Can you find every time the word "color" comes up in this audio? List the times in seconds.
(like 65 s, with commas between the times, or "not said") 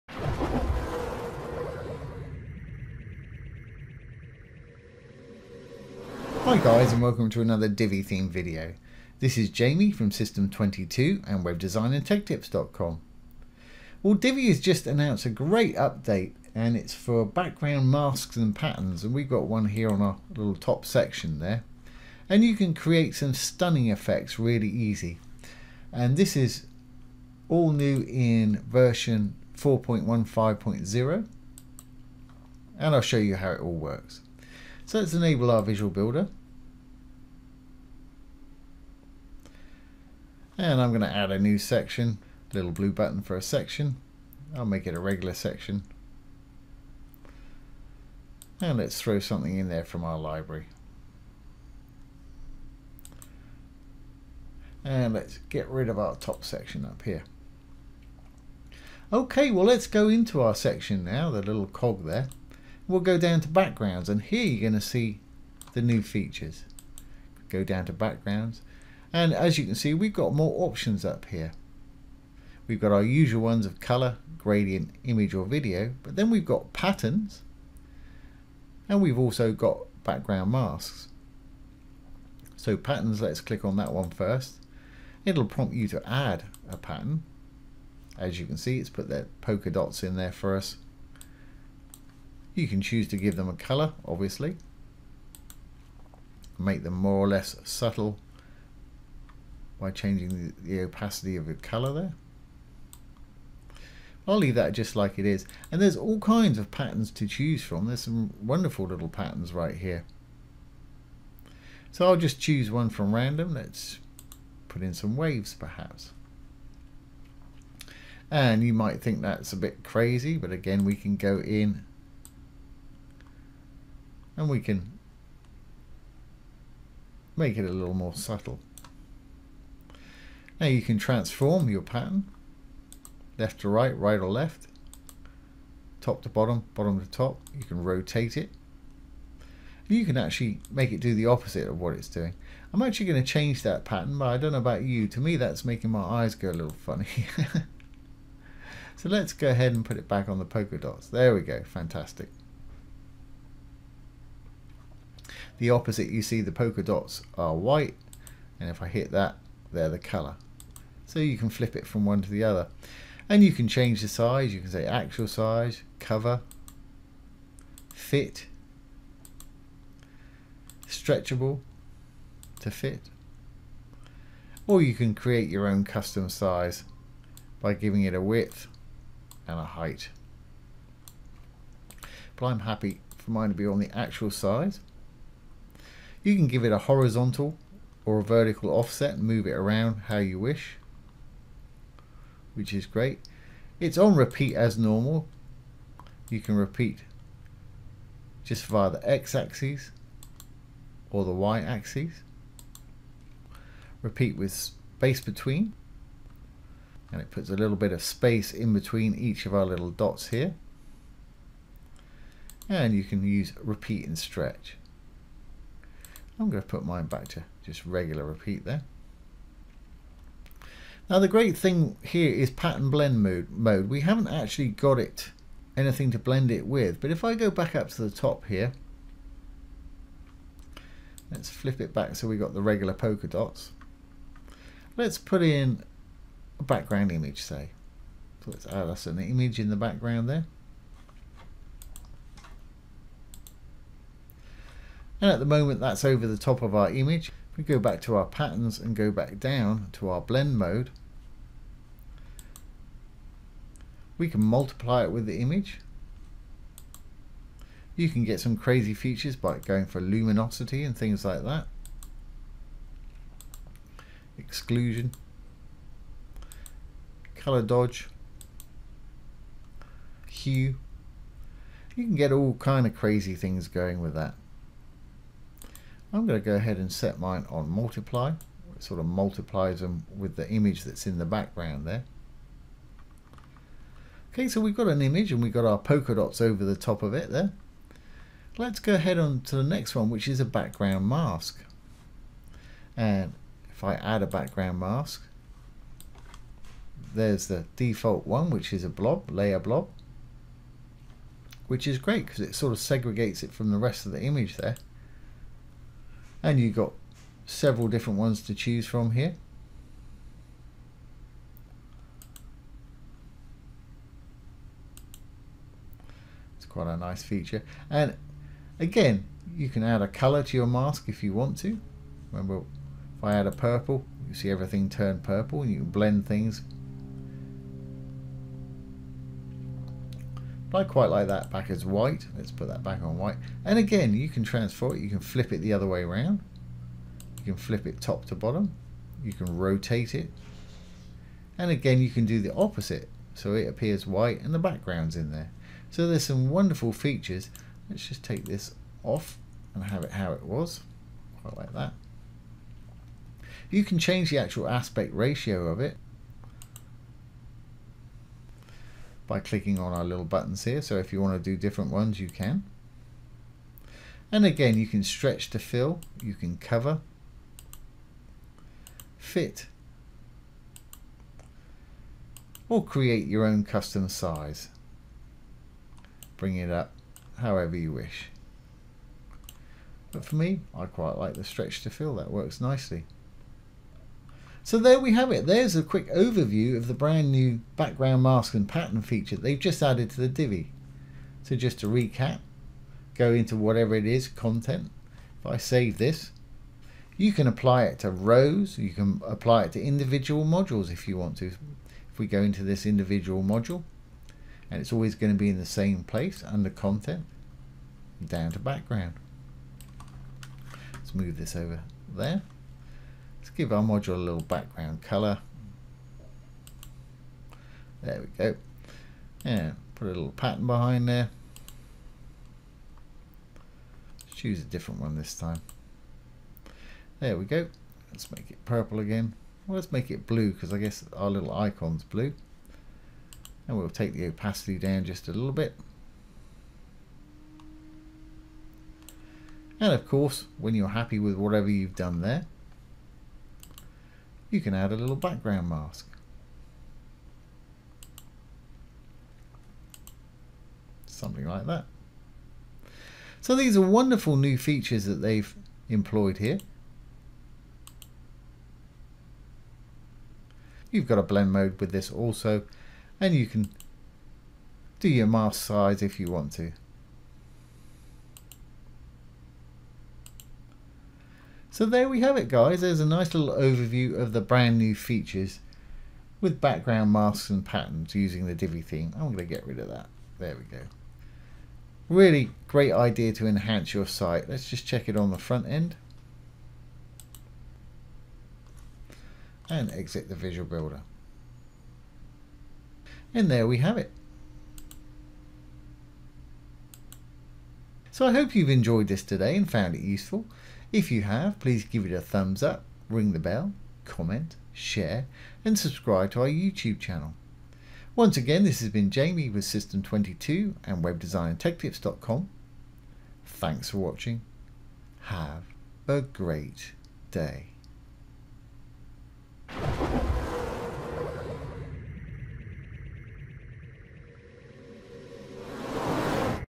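73 s, 93 s, 101 s, 159 s, 267 s, 320 s, 415 s.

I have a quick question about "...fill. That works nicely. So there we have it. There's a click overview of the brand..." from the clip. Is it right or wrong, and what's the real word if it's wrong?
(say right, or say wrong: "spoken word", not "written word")
wrong: "quick", not "click".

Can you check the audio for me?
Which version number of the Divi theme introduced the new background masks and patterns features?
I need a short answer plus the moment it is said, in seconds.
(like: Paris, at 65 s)
4.15.0, at 29 s.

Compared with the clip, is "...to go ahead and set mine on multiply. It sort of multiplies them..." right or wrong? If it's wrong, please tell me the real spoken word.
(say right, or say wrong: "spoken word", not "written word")
right.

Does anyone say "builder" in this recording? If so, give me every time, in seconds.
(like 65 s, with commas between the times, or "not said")
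35 s, 490 s.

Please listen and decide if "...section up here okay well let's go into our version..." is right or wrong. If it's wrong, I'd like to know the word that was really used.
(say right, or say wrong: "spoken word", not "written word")
wrong: "section", not "version".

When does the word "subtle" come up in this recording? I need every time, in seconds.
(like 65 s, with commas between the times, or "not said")
97 s, 128 s.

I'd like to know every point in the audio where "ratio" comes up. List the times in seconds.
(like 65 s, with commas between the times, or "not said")
355 s.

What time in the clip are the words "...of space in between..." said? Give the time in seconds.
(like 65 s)
207 s.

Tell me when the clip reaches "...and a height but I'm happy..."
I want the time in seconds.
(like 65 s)
179 s.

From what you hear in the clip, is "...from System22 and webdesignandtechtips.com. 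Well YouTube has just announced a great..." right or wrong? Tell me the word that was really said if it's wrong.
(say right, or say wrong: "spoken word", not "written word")
wrong: "Divi", not "YouTube".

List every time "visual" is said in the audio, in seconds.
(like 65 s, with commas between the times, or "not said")
35 s, 490 s.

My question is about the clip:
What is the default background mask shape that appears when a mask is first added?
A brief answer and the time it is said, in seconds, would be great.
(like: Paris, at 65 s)
Layer blob, at 299 s.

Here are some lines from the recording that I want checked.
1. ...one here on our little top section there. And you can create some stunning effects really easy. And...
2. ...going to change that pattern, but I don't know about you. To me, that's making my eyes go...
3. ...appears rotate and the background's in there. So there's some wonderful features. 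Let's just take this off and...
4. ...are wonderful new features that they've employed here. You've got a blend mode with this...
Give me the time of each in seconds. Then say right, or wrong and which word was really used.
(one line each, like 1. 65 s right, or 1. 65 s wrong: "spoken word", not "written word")
1. 19 s right
2. 143 s right
3. 343 s wrong: "white", not "rotate"
4. 453 s right.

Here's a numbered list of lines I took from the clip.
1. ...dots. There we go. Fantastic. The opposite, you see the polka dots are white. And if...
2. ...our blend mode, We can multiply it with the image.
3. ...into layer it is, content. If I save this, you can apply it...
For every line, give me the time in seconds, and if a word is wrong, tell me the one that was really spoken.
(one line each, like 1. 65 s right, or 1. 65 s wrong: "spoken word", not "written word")
1. 150 s right
2. 250 s right
3. 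393 s wrong: "whatever", not "layer".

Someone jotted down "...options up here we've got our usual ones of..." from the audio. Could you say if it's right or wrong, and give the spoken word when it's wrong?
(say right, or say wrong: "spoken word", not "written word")
right.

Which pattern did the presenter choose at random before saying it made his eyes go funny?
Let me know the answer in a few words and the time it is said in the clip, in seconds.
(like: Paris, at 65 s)
Waves, at 115 s.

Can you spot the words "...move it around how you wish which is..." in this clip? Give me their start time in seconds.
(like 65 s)
189 s.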